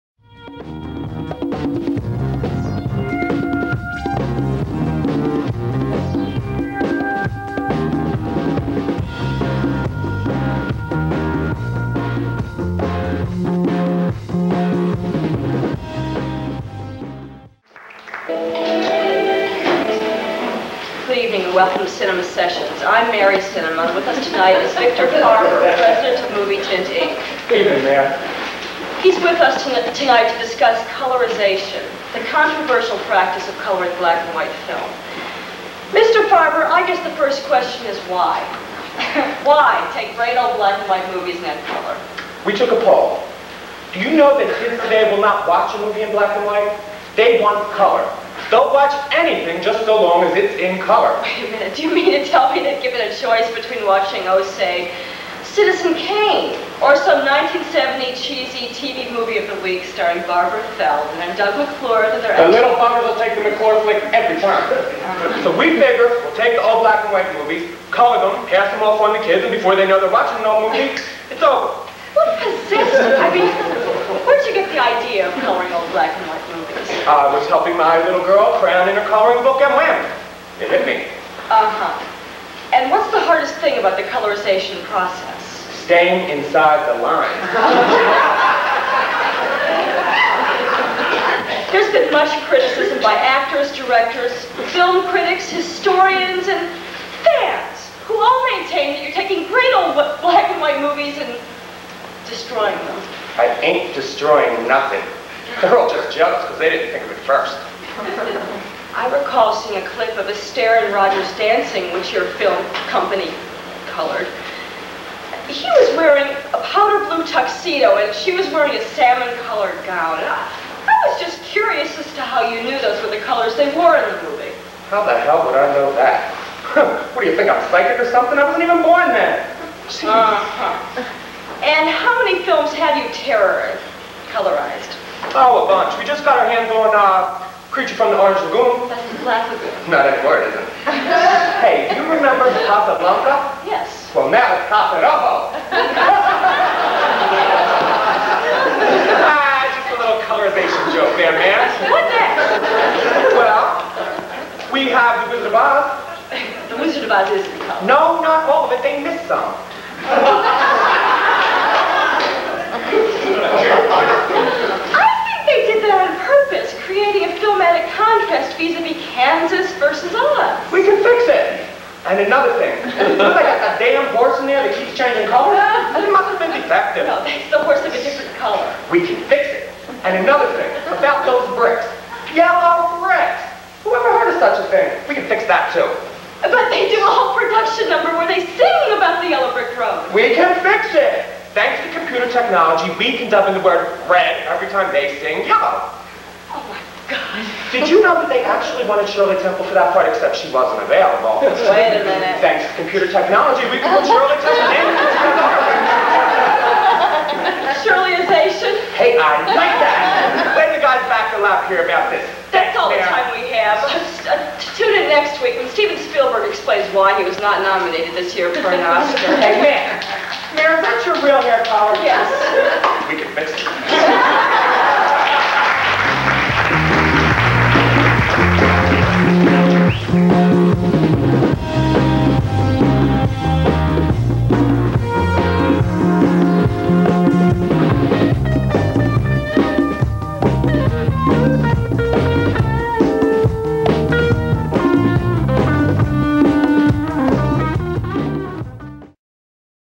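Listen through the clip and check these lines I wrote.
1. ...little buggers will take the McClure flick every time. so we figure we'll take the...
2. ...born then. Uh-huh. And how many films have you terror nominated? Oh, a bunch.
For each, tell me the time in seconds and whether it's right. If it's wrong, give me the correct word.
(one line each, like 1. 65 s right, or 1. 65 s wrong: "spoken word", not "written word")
1. 62 s right
2. 128 s wrong: "colorized", not "nominated".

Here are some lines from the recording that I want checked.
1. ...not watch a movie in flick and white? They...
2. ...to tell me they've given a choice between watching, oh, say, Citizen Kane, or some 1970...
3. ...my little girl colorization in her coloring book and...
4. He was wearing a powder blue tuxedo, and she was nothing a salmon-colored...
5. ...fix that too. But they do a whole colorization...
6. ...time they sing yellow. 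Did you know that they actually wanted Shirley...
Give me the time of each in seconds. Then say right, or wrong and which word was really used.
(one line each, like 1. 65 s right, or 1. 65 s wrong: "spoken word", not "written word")
1. 45 s wrong: "black", not "flick"
2. 52 s right
3. 77 s wrong: "crayon", not "colorization"
4. 115 s wrong: "wearing", not "nothing"
5. 185 s wrong: "production", not "colorization"
6. 194 s right.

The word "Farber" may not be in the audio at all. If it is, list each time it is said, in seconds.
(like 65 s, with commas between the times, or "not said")
25 s, 36 s.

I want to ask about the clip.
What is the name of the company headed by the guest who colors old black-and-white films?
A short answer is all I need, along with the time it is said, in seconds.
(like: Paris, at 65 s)
Movie Tint Inc., at 26 s.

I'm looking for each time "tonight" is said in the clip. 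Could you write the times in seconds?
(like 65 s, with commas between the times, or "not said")
24 s, 29 s.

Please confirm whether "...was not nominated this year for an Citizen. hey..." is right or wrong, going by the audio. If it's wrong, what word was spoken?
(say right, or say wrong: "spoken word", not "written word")
wrong: "Oscar", not "Citizen".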